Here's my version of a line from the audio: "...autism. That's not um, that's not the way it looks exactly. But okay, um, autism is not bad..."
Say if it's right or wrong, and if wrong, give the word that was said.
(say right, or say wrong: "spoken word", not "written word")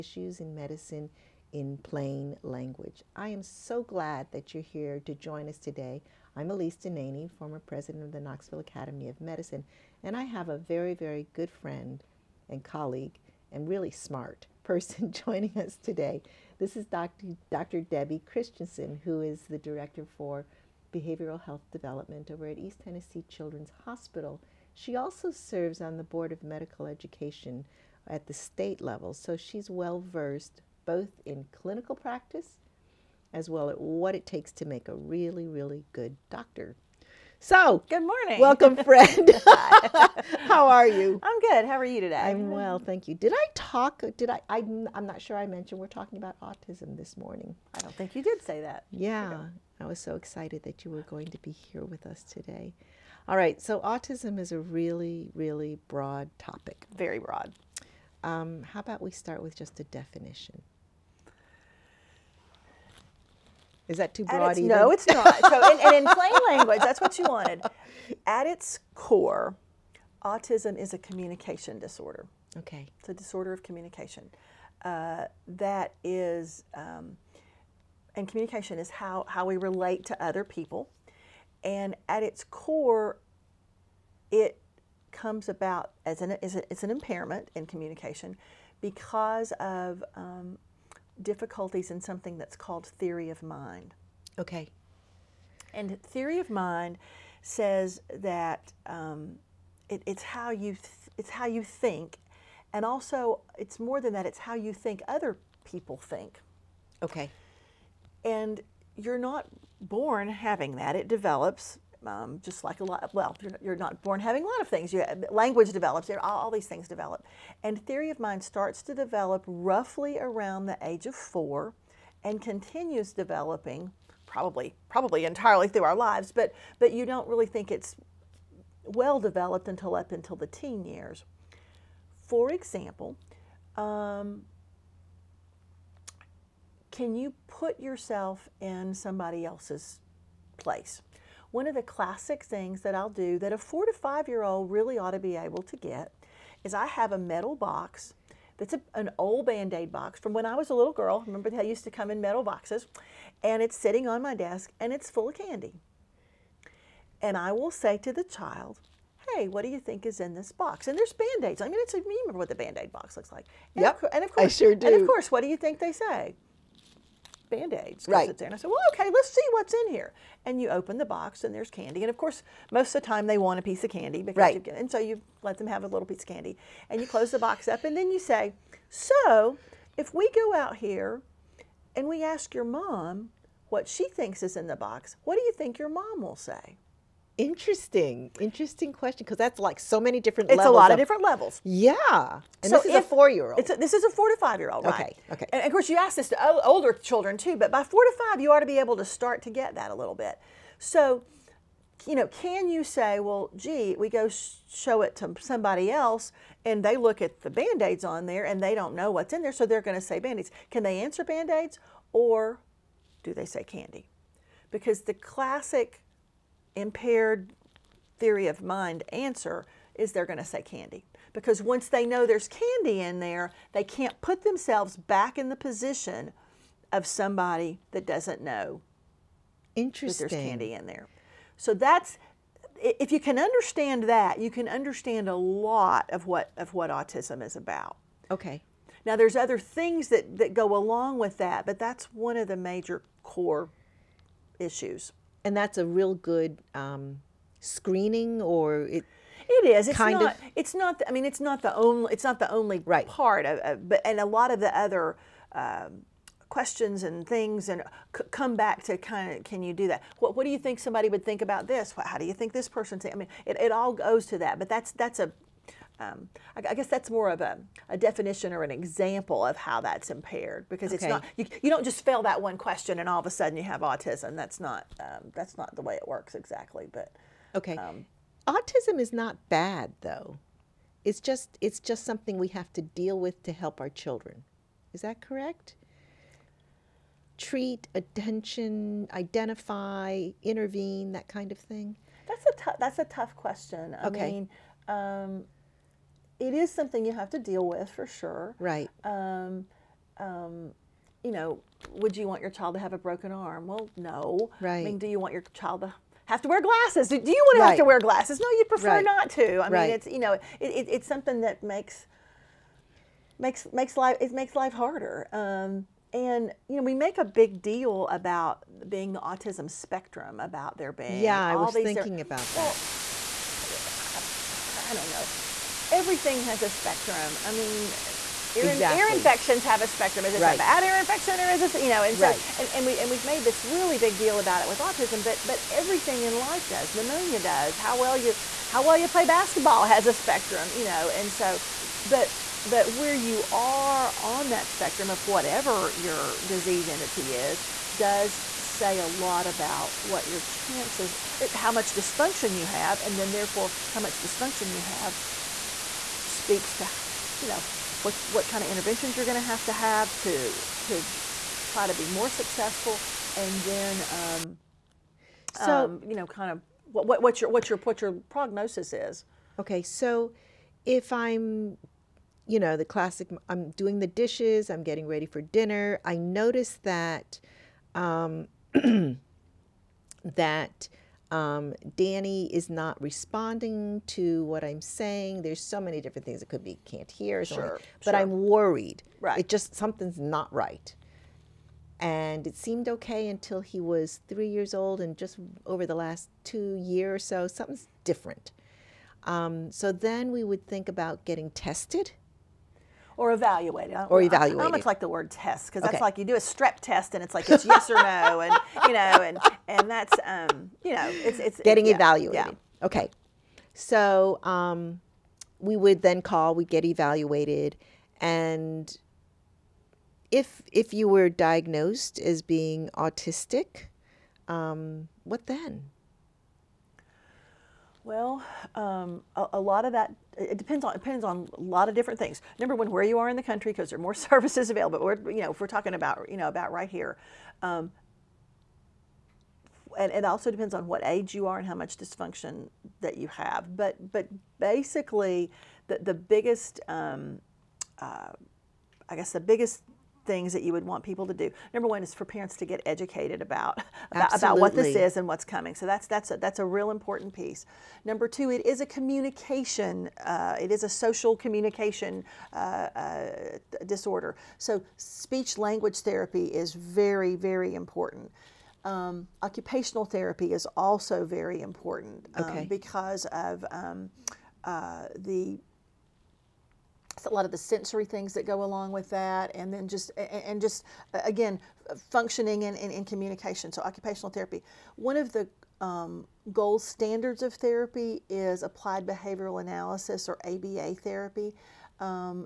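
wrong: "works", not "looks".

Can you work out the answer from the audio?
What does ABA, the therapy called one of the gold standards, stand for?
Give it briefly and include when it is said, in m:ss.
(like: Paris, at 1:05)
Applied behavioral analysis, at 8:08.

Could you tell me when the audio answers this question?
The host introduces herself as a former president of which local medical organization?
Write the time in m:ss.
0:08.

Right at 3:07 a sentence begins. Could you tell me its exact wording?
Interesting, interesting question because that's like so many different.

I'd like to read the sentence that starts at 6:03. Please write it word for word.
And then, um, so, um, you know, kind of what, what, what, your, what, your, what your prognosis is.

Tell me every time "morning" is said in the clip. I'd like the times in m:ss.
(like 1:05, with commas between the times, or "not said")
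0:38, 0:47.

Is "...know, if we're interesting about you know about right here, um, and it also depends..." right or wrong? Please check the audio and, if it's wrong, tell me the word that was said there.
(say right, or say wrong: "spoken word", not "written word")
wrong: "talking", not "interesting".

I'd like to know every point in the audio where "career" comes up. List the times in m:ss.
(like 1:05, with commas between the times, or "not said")
not said.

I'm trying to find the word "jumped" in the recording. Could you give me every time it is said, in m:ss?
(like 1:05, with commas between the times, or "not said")
not said.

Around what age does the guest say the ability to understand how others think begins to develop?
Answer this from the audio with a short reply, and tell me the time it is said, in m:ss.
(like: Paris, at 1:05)
4, at 2:00.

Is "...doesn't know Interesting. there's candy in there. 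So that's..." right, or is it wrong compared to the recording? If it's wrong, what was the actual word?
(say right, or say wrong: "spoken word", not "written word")
right.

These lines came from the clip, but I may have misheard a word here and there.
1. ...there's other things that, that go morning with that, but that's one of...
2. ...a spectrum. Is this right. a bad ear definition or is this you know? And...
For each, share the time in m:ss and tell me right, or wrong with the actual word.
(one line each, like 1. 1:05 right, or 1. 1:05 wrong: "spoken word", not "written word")
1. 3:59 wrong: "along", not "morning"
2. 5:29 wrong: "infection", not "definition".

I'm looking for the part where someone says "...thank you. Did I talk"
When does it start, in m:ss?
0:42.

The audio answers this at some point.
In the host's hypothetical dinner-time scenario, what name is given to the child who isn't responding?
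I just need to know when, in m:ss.
6:21.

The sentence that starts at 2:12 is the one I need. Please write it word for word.
For example, um, can you put yourself in somebody else's place?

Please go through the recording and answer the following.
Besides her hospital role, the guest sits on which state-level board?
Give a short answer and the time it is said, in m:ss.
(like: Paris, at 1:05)
Board of Medical Education, at 0:26.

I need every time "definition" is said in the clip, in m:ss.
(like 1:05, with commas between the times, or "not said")
0:59, 4:27.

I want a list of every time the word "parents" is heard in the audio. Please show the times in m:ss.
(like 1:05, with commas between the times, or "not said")
7:32.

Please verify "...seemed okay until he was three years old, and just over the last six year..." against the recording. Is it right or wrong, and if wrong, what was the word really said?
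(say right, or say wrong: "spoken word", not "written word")
wrong: "two", not "six".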